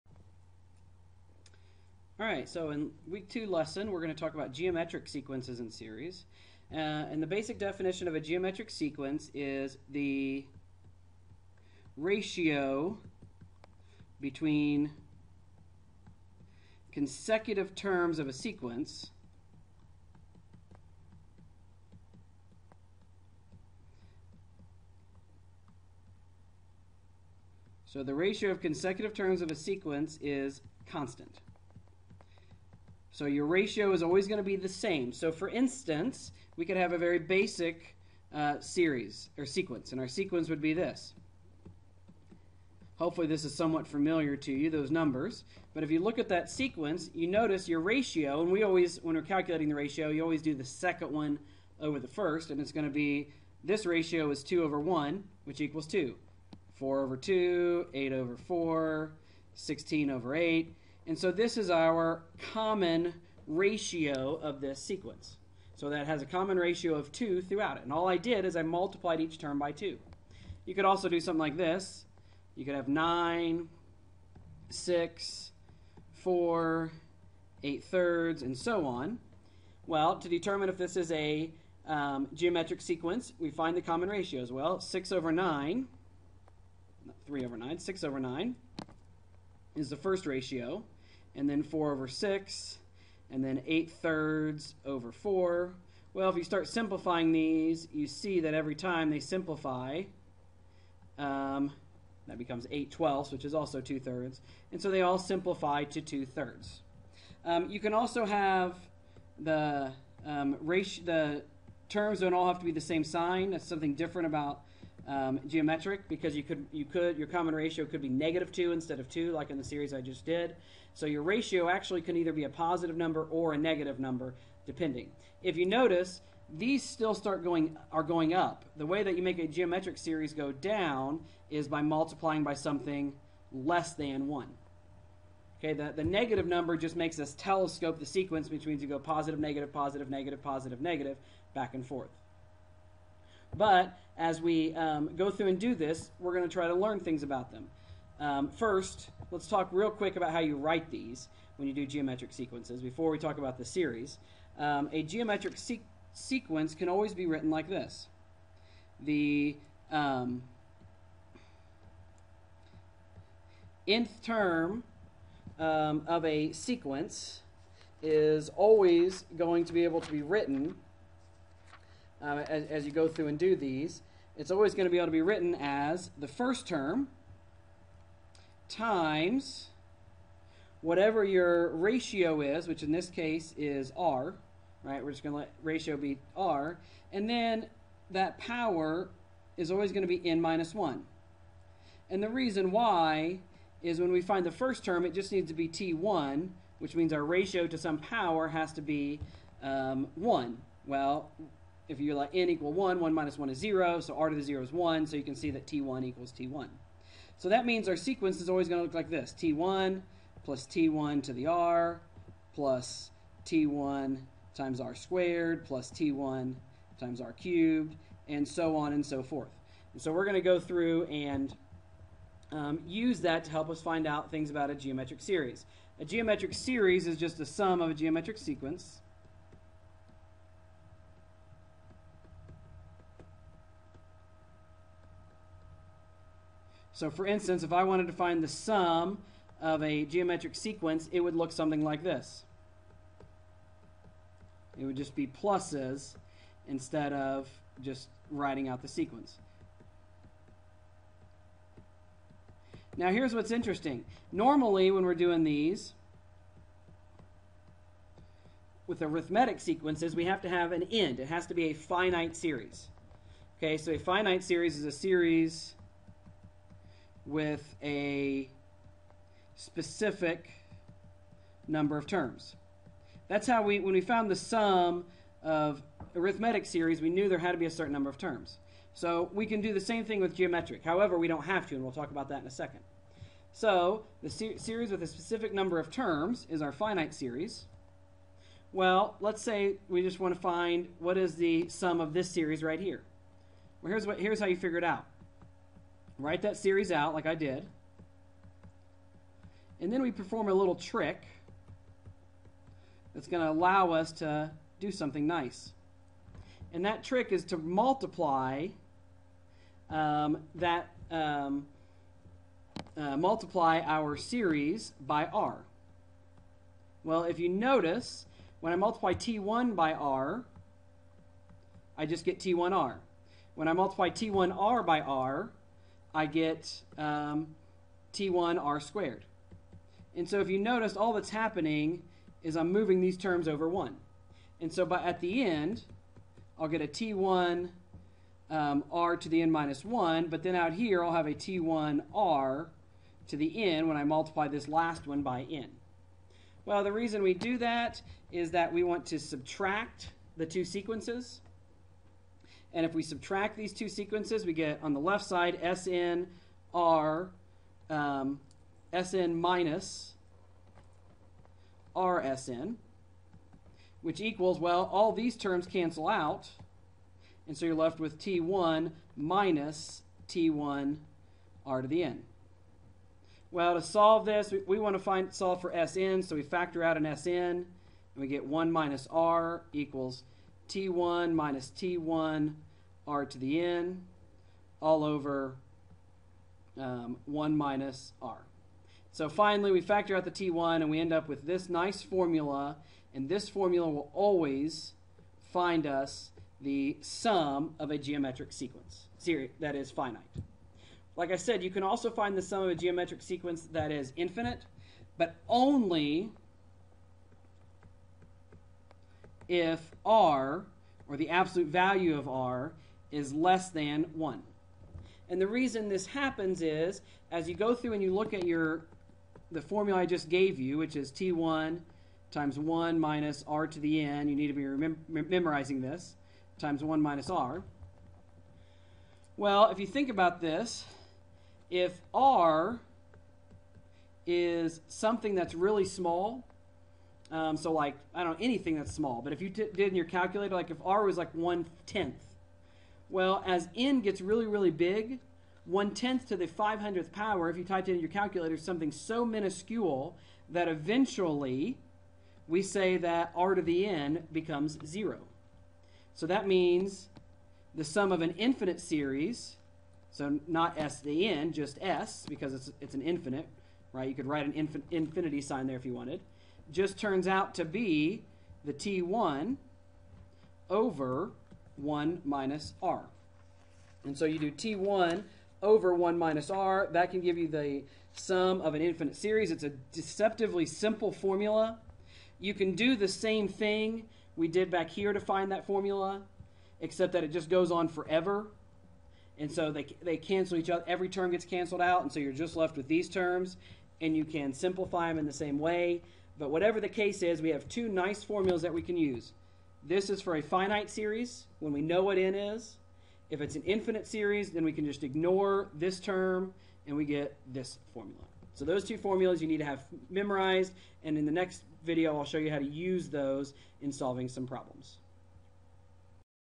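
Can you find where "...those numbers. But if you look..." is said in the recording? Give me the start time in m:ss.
0:44.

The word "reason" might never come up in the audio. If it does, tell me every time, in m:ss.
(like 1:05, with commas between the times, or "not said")
3:12, 5:46, 6:55.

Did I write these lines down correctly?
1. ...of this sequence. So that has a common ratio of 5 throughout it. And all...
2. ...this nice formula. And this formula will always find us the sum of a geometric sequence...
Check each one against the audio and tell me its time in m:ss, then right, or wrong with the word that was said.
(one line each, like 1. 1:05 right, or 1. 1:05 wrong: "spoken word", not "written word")
1. 1:04 wrong: "2", not "5"
2. 6:31 right.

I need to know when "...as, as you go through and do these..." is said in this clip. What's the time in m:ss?
2:52.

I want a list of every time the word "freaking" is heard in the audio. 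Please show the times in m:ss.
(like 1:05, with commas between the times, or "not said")
not said.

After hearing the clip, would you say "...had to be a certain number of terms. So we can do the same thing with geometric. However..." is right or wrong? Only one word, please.
right.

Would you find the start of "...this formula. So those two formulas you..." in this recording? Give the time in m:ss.
8:27.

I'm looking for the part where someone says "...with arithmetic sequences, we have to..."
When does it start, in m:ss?
4:18.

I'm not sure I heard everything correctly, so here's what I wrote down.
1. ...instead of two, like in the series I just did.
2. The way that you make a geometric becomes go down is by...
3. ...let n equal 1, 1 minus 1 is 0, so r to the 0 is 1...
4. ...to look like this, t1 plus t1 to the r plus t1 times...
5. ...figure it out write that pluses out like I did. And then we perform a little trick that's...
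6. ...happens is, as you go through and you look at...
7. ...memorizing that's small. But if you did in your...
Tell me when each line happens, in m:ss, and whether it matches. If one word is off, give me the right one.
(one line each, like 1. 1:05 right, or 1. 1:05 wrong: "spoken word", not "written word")
1. 1:58 right
2. 2:08 wrong: "series", not "becomes"
3. 3:22 right
4. 3:28 right
5. 4:54 wrong: "series", not "pluses"
6. 6:56 right
7. 7:18 wrong: "anything", not "memorizing".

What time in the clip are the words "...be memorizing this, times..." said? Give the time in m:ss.
7:05.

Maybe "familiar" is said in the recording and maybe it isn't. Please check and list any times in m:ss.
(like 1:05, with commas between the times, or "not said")
0:43.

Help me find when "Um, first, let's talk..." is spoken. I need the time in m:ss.
2:28.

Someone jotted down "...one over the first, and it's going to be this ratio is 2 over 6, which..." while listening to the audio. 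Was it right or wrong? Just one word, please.
wrong.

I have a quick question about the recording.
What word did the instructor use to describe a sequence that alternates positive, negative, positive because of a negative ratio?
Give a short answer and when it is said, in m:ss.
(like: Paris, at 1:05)
telescope, at 2:17.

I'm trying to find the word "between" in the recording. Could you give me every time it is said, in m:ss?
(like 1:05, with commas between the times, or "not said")
0:14.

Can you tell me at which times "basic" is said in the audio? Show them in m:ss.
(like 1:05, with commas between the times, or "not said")
0:07, 0:37.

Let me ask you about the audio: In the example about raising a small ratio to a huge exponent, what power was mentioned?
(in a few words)
500th.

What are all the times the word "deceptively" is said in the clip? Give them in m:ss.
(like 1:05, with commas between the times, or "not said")
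7:59.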